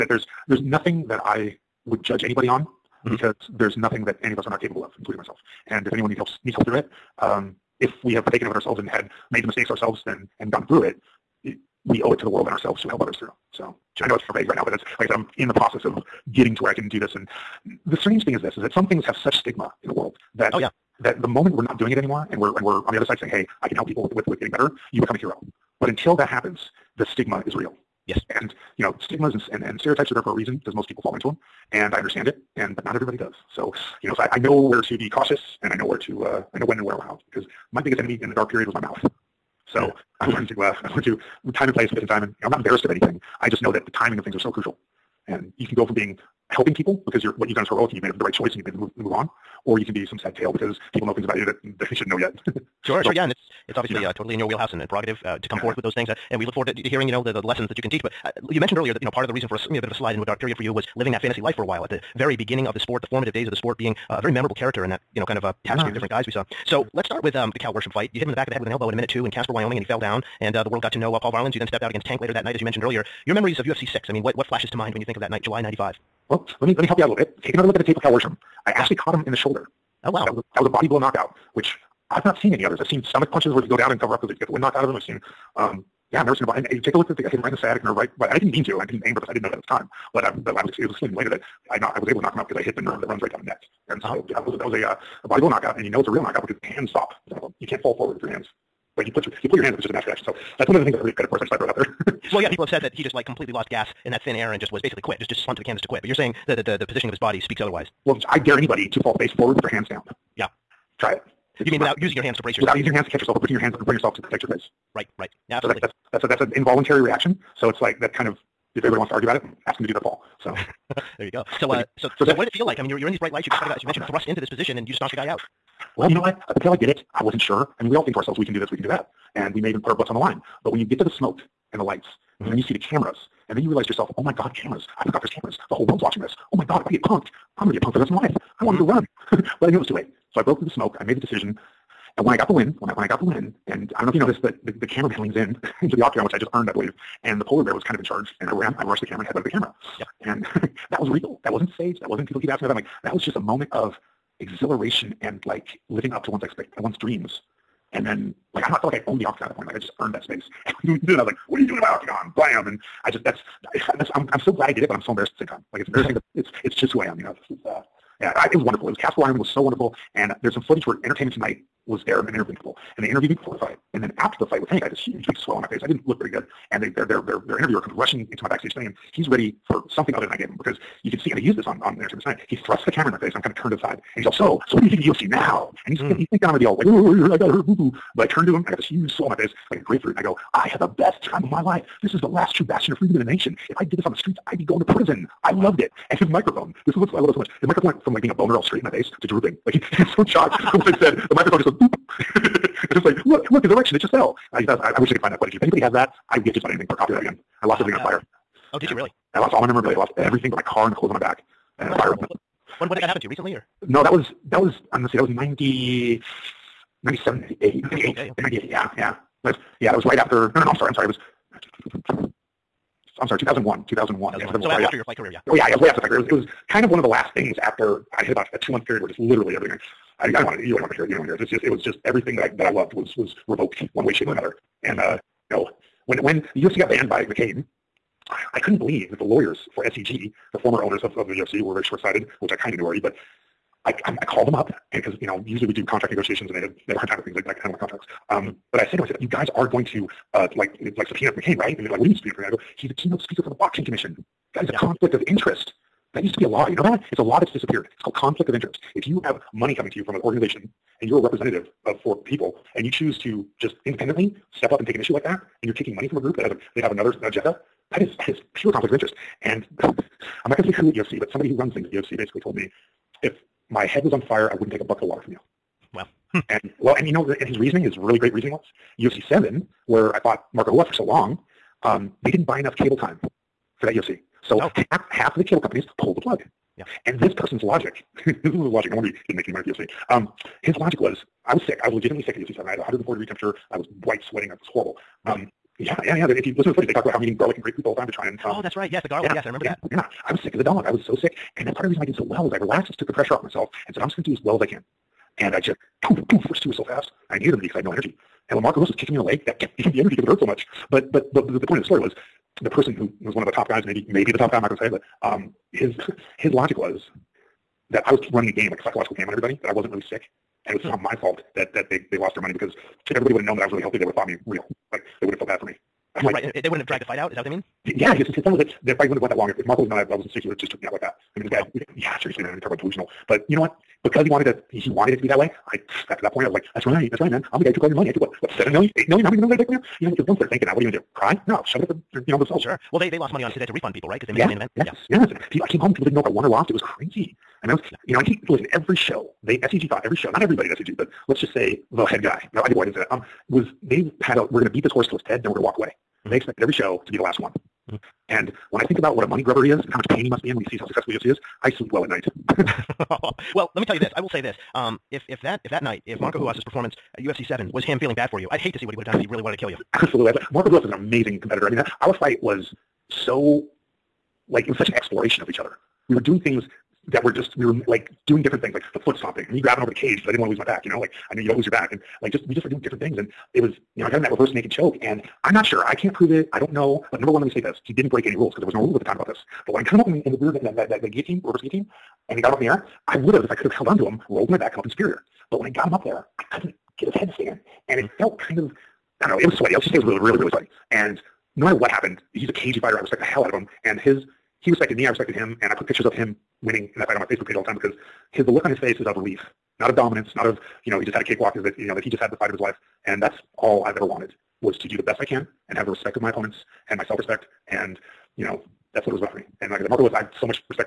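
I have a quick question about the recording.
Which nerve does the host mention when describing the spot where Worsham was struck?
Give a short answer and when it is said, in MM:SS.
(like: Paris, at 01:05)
Sciatic nerve, at 01:27.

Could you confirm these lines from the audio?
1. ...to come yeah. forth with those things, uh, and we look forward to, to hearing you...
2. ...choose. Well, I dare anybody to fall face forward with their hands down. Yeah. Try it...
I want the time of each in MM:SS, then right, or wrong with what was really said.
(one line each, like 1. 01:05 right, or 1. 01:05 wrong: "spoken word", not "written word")
1. 00:55 right
2. 01:47 wrong: "otherwise", not "choose".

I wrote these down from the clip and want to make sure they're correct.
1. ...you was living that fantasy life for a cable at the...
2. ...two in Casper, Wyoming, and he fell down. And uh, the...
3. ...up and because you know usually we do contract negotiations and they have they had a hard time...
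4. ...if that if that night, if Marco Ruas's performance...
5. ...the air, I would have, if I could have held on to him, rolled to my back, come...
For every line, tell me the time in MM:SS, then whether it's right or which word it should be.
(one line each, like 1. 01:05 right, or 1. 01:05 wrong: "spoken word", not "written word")
1. 01:00 wrong: "while", not "cable"
2. 01:09 right
3. 04:04 right
4. 06:05 right
5. 06:32 right.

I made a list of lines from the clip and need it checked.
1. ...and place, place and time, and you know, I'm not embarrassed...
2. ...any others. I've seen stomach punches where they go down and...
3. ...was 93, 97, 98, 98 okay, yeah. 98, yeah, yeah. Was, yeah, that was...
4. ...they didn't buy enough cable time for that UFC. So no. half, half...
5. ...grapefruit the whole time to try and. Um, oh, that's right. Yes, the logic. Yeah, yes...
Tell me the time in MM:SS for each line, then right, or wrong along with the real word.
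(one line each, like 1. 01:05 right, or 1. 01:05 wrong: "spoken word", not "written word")
1. 00:41 right
2. 01:22 right
3. 03:35 wrong: "90", not "93"
4. 04:42 right
5. 04:57 wrong: "garlic", not "logic".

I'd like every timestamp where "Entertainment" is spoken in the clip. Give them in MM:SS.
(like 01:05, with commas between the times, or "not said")
02:51, 03:02.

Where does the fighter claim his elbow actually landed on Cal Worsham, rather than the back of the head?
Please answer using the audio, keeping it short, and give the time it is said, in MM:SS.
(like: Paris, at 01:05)
Shoulder, at 01:19.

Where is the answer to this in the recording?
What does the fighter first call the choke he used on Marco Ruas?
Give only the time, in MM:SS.
06:24.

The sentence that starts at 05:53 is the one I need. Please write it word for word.
Um, was they had a we're going to beat this horse till it's dead, then we're going to walk away.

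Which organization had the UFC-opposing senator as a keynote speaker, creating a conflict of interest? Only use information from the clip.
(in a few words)
Boxing commission.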